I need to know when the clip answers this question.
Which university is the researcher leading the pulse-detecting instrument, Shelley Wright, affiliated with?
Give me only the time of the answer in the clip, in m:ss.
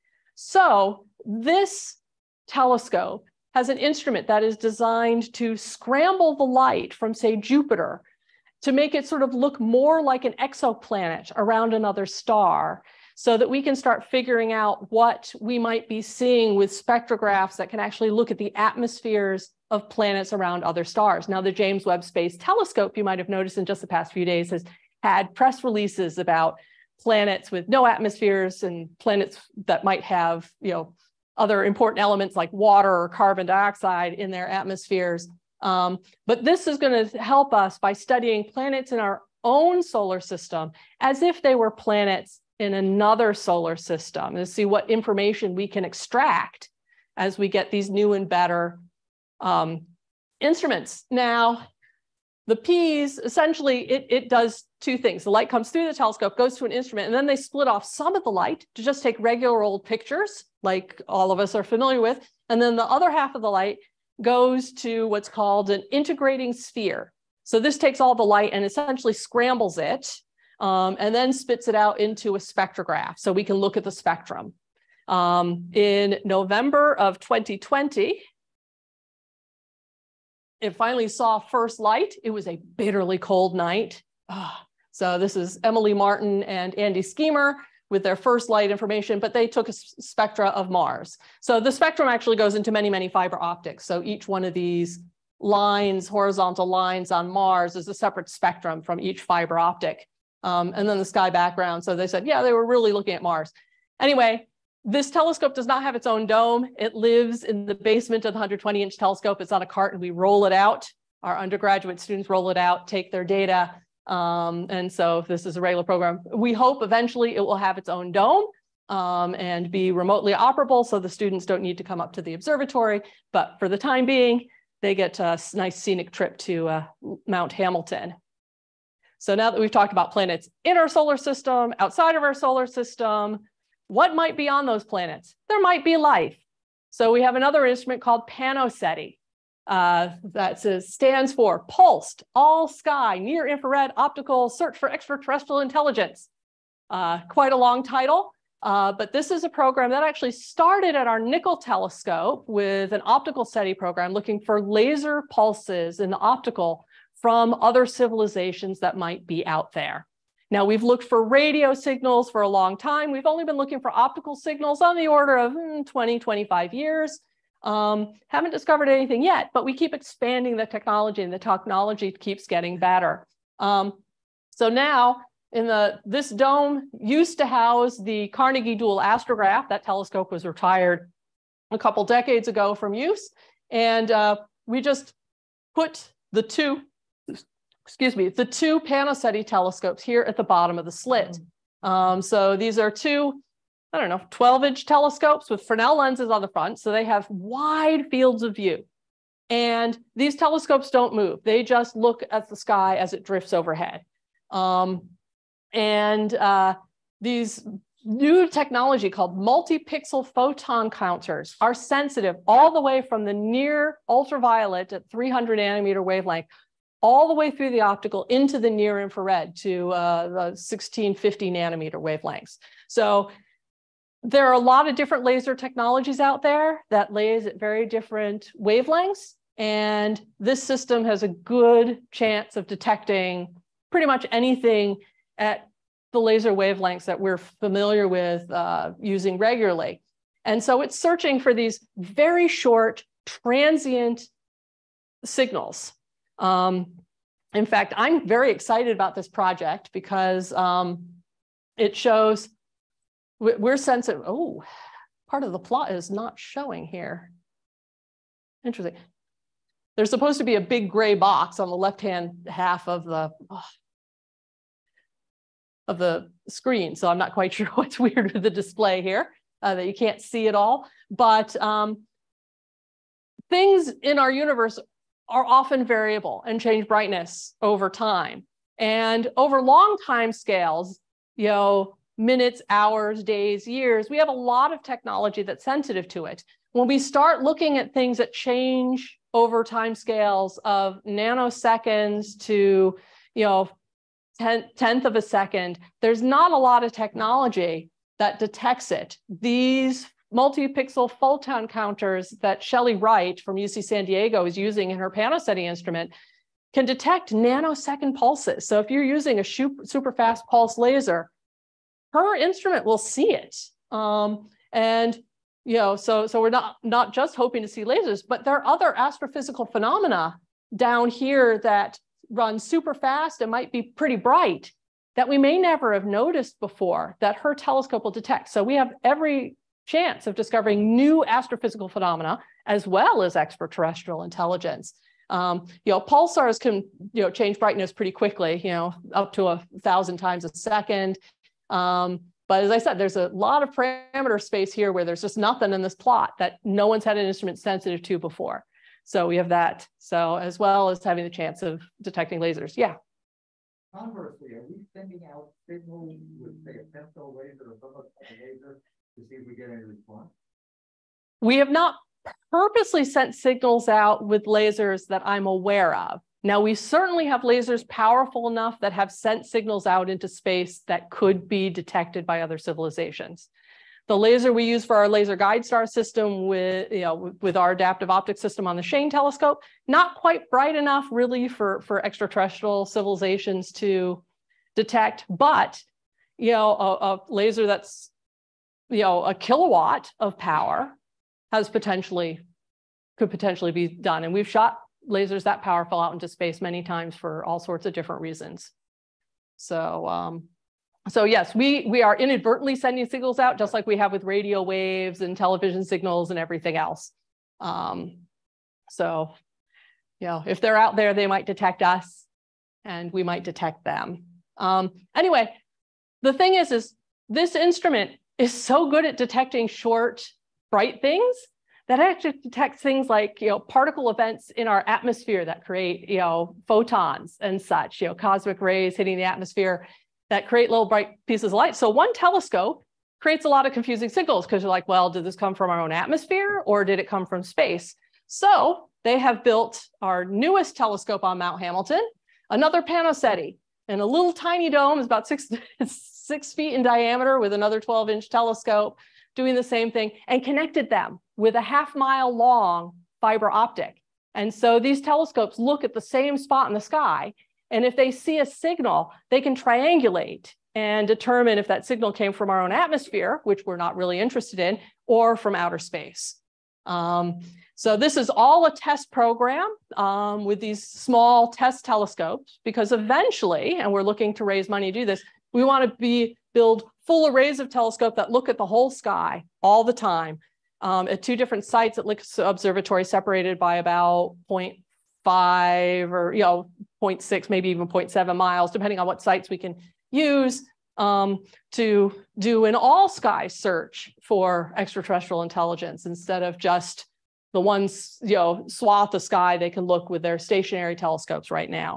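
5:03.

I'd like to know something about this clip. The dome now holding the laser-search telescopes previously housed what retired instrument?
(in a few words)
Carnegie dual astrograph.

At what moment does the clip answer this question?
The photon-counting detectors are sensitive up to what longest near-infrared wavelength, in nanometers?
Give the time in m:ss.
3:40.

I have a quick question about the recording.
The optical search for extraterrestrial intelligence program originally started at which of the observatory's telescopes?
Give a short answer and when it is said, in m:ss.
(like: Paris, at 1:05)
Nickel telescope, at 2:31.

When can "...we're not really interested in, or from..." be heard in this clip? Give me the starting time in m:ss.
7:43.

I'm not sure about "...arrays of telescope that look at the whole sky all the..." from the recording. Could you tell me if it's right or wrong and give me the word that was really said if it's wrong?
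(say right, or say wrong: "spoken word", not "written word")
right.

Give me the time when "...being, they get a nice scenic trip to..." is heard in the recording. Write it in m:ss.
2:04.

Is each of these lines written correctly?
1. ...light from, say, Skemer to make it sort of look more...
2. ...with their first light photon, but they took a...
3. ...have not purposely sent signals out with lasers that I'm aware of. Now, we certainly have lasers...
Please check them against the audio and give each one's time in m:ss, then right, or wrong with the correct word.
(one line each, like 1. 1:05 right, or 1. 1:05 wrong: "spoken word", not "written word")
1. 0:06 wrong: "Jupiter", not "Skemer"
2. 1:27 wrong: "information", not "photon"
3. 6:01 right.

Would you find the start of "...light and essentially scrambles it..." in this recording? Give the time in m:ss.
1:08.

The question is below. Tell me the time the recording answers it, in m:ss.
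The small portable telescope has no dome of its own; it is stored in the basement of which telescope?
1:48.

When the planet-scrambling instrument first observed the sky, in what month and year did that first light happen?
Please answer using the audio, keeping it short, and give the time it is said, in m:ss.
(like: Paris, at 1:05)
November 2020, at 1:16.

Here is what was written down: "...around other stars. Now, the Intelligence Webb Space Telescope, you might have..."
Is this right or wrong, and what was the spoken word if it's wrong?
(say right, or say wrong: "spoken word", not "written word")
wrong: "James", not "Intelligence".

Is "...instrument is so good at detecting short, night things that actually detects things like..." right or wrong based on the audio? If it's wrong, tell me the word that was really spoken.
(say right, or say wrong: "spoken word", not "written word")
wrong: "bright", not "night".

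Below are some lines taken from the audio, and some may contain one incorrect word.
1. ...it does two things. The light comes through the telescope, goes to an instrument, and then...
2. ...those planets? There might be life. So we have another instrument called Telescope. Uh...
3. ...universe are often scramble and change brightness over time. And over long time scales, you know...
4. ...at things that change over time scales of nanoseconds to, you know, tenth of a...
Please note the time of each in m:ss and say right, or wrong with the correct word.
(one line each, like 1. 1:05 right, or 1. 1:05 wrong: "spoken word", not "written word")
1. 0:54 right
2. 2:14 wrong: "PANOSETI", not "Telescope"
3. 4:34 wrong: "variable", not "scramble"
4. 4:47 right.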